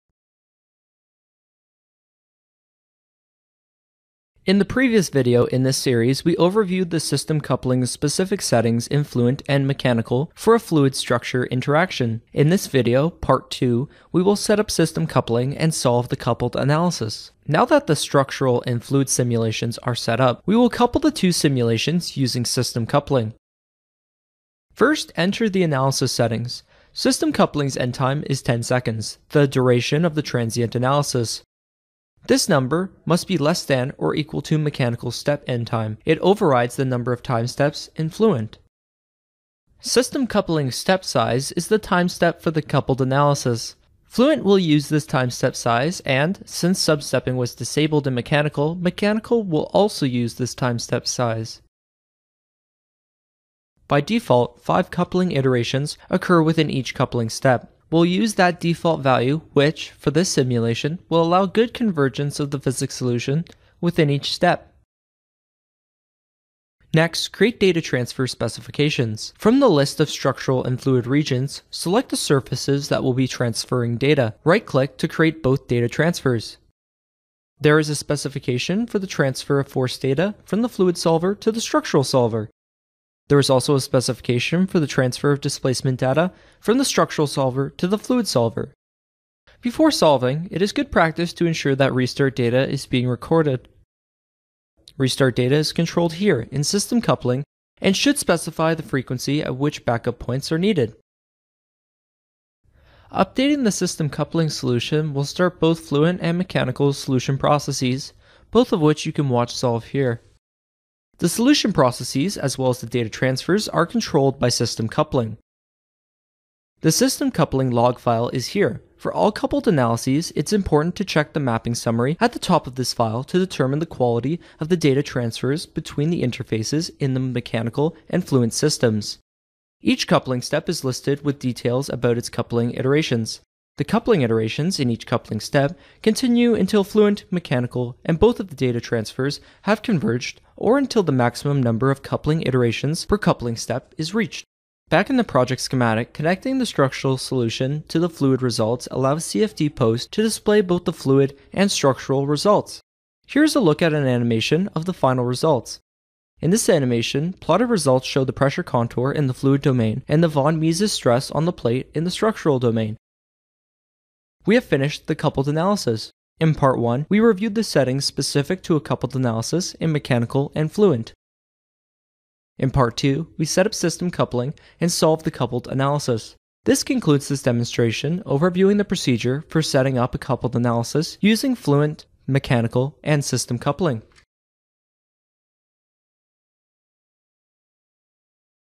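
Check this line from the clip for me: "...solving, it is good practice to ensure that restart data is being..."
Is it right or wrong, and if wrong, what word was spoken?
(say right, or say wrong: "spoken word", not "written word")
right.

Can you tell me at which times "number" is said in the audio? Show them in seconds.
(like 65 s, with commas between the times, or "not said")
32 s, 36 s, 141 s.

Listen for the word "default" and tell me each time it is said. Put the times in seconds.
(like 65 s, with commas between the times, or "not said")
54 s, 58 s.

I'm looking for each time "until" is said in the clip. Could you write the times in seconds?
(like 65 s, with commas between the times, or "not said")
136 s, 140 s.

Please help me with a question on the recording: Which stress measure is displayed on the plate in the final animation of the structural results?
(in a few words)
von Mises stress.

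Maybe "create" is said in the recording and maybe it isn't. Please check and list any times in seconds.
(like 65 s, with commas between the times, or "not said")
67 s, 75 s.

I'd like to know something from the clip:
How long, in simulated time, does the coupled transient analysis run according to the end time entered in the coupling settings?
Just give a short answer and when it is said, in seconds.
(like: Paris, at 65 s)
10 seconds, at 28 s.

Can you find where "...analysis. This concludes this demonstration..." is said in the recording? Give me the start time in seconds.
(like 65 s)
175 s.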